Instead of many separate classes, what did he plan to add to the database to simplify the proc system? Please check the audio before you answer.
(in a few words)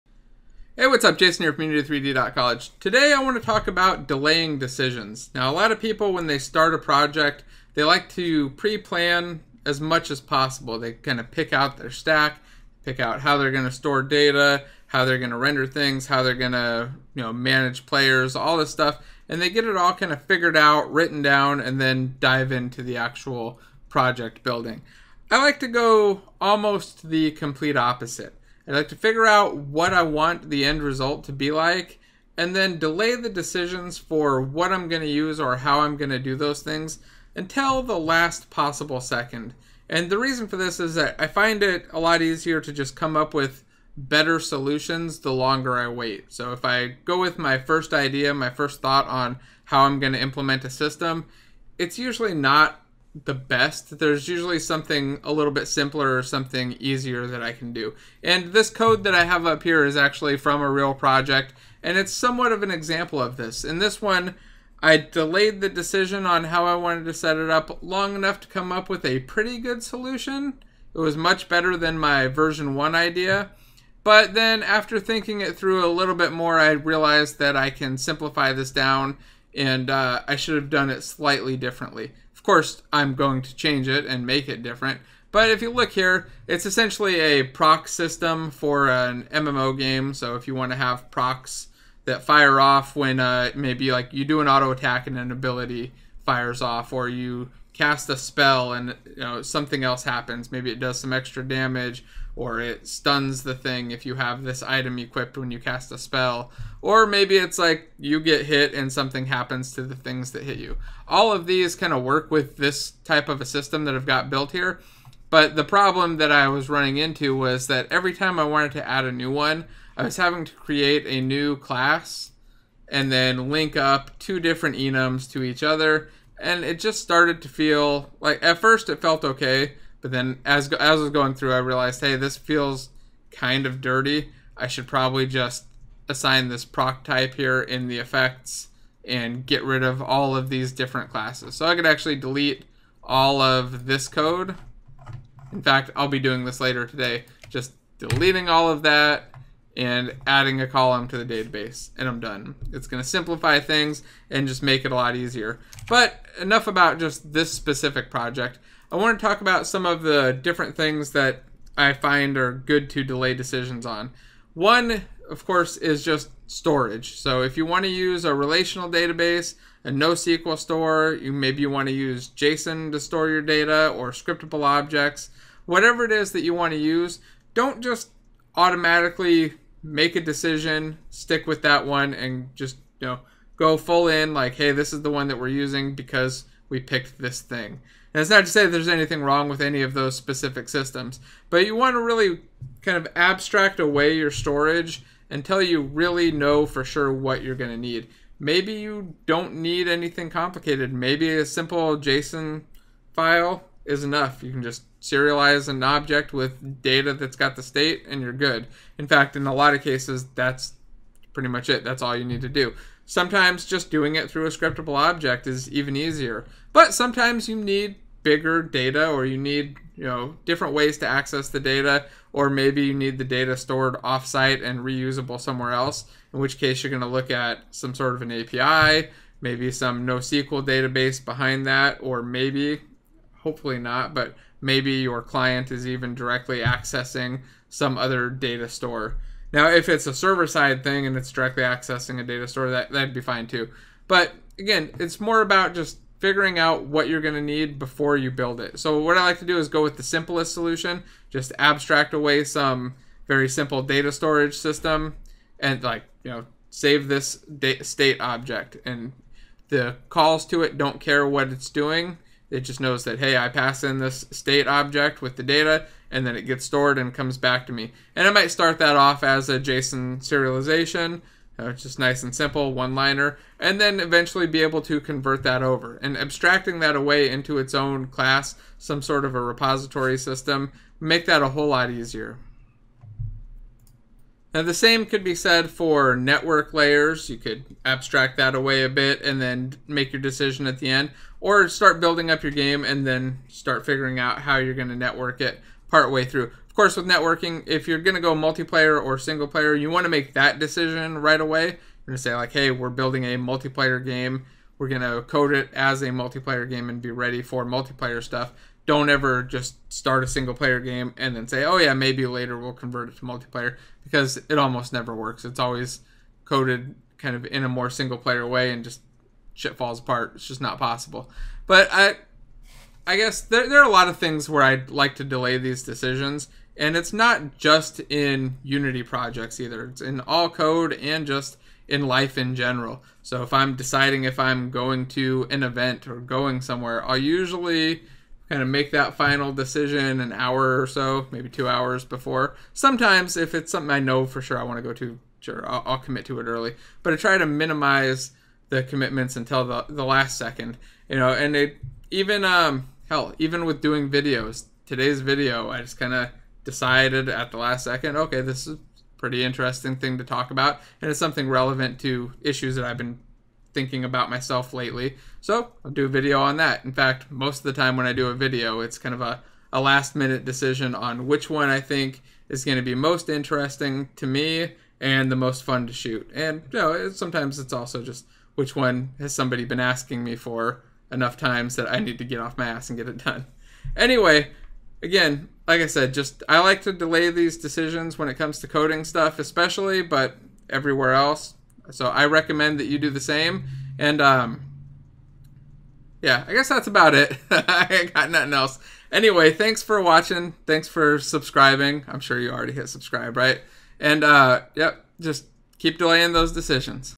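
a column.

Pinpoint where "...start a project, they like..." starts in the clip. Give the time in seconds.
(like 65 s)
6 s.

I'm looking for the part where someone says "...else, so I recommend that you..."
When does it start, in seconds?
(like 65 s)
391 s.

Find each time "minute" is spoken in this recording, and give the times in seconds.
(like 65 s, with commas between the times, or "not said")
370 s.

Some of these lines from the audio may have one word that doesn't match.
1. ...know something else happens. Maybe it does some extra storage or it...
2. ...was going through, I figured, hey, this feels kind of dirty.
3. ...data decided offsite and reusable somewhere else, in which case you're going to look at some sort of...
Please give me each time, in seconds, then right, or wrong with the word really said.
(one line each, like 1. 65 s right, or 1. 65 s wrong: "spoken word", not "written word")
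1. 99 s wrong: "damage", not "storage"
2. 131 s wrong: "realized", not "figured"
3. 223 s wrong: "stored", not "decided".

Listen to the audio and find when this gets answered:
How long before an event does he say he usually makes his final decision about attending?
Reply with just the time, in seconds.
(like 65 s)
340 s.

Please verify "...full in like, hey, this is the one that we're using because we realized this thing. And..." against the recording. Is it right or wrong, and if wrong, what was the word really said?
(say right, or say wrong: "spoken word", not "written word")
wrong: "picked", not "realized".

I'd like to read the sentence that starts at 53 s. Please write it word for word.
There's usually something a little bit simpler or something easier that I can do.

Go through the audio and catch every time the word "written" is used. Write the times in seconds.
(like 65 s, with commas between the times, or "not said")
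20 s.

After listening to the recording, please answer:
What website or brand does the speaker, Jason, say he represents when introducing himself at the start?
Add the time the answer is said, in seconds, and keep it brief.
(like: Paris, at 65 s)
Unity3D.College, at 1 s.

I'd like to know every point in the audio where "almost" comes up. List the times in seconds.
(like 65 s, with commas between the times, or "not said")
26 s, 314 s.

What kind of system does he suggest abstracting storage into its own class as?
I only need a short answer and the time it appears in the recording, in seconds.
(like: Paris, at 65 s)
a repository system, at 279 s.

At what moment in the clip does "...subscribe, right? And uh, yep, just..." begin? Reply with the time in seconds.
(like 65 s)
402 s.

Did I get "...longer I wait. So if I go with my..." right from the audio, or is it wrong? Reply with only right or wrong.
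right.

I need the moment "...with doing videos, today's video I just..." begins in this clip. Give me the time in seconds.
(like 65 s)
353 s.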